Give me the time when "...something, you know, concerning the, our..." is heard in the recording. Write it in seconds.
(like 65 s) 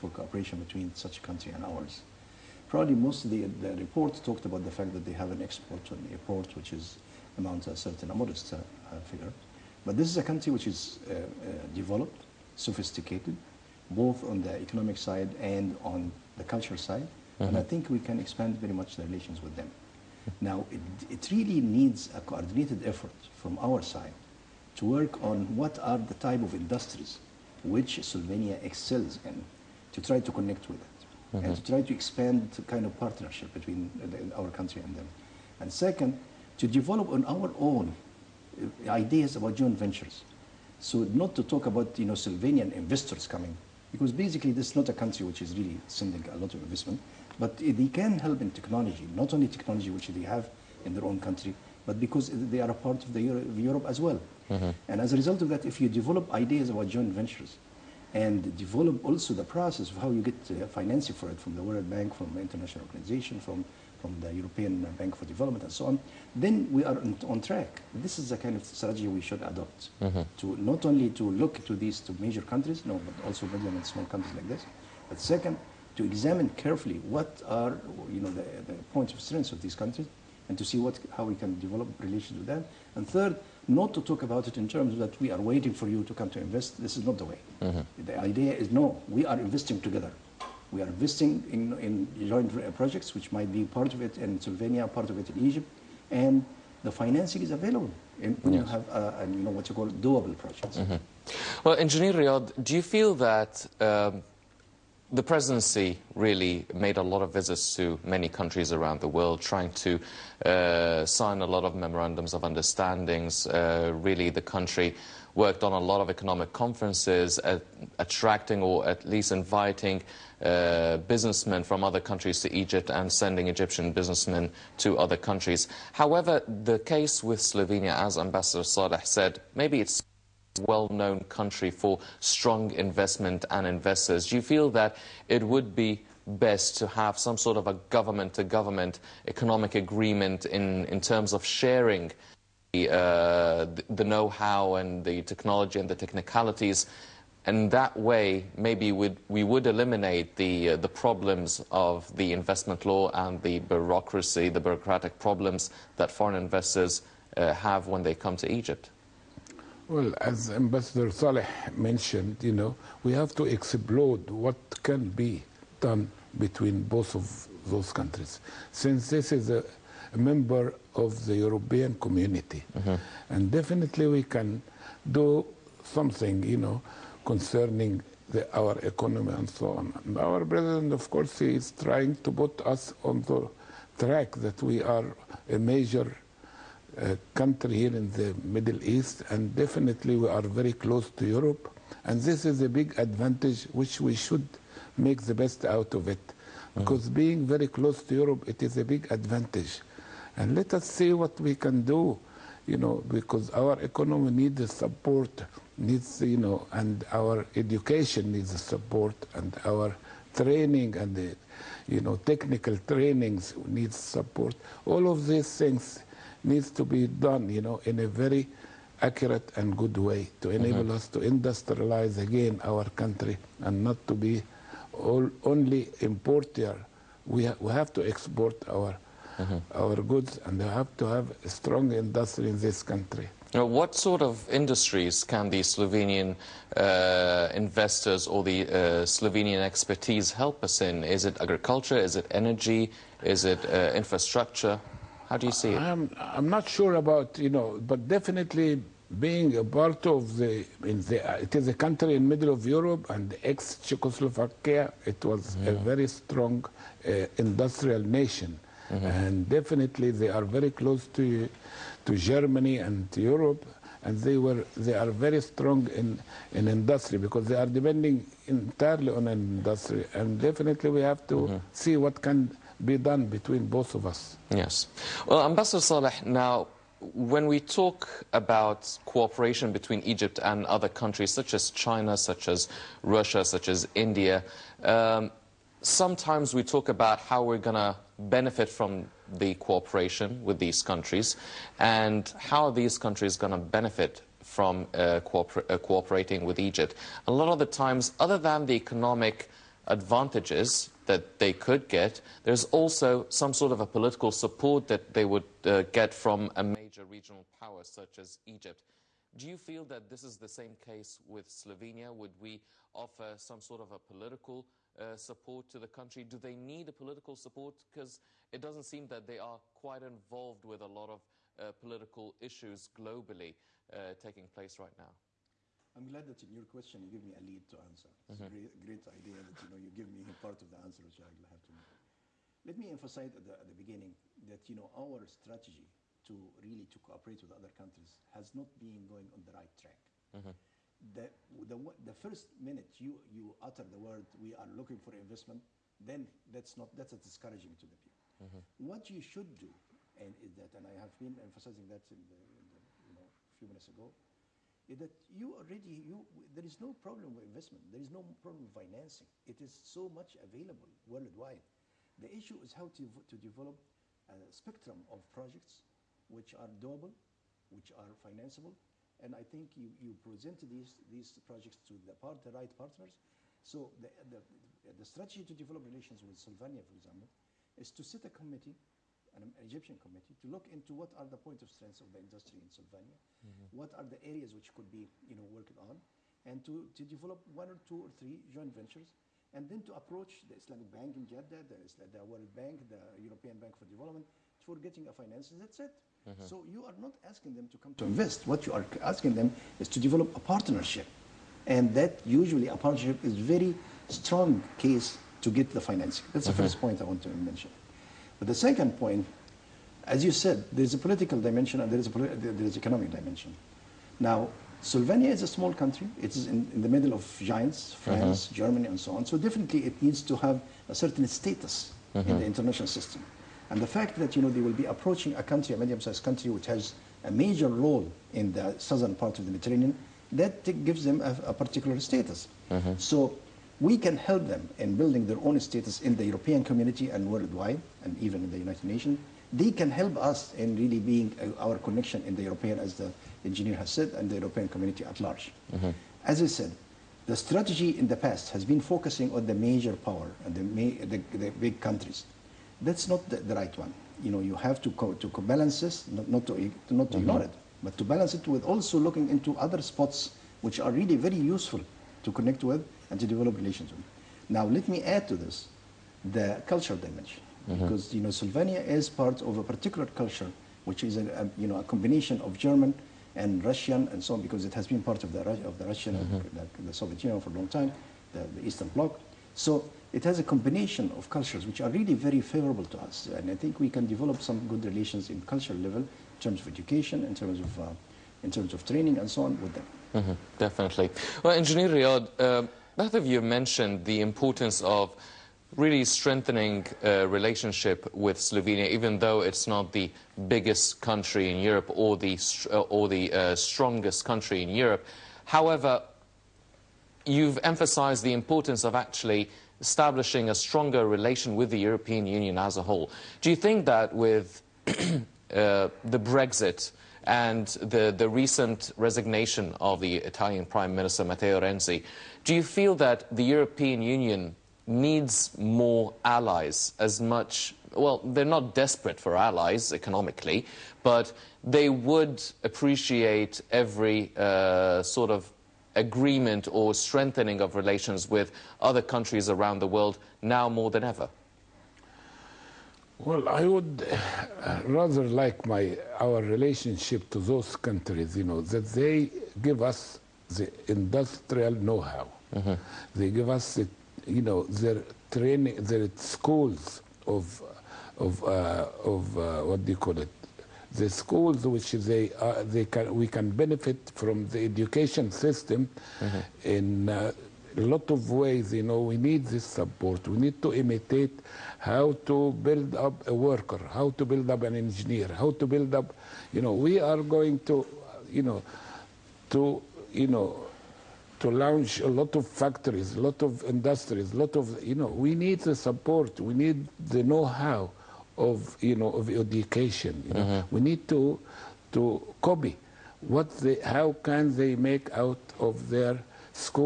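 175 s.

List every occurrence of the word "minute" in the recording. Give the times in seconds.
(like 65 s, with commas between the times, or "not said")
342 s, 353 s.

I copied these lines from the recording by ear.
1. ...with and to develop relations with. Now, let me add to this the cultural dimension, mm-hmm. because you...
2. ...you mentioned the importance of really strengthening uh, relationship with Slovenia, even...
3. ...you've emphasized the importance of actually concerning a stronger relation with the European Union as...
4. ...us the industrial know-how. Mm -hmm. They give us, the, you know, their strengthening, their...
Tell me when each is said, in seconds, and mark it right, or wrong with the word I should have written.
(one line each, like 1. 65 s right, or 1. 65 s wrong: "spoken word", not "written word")
1. 462 s right
2. 493 s right
3. 507 s wrong: "establishing", not "concerning"
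4. 549 s wrong: "training", not "strengthening".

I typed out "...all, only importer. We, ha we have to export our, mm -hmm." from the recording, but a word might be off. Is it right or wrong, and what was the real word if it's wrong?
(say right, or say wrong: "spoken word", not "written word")
right.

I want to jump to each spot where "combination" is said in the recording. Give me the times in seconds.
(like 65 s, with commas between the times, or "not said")
471 s, 480 s.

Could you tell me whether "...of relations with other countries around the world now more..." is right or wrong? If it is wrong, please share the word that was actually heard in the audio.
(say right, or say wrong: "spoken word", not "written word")
right.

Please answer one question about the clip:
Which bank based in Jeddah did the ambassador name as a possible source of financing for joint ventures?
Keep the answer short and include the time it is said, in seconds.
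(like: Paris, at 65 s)
Islamic Bank, at 390 s.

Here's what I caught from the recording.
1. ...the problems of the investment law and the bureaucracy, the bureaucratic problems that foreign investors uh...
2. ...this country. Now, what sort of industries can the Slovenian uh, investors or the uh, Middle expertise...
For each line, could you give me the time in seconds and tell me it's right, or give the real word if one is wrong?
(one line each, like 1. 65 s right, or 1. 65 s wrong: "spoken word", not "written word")
1. 150 s right
2. 232 s wrong: "Slovenian", not "Middle".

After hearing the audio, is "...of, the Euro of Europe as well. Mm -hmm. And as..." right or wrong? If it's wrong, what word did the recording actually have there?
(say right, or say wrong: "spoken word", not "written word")
right.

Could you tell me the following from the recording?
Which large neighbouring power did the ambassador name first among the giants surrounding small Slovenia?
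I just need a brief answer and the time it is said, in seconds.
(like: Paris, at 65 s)
France, at 418 s.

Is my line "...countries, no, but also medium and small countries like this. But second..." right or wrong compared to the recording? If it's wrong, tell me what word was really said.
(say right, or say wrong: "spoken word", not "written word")
right.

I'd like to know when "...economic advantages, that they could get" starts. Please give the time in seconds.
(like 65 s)
298 s.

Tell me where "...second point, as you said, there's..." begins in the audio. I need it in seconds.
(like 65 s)
408 s.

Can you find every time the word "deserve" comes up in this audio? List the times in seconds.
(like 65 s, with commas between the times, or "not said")
not said.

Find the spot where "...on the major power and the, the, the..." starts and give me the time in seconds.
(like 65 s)
449 s.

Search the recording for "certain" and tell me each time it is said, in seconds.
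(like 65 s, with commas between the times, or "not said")
7 s, 420 s.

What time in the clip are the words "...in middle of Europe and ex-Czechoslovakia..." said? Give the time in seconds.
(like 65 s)
252 s.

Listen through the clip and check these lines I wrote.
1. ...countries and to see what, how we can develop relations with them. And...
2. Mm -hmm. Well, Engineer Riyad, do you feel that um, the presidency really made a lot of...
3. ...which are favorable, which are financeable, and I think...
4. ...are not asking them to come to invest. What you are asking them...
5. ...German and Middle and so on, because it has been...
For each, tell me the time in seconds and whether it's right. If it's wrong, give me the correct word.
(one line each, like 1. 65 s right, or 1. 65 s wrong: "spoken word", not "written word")
1. 79 s right
2. 100 s right
3. 366 s wrong: "doable", not "favorable"
4. 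396 s right
5. 472 s wrong: "Russian", not "Middle".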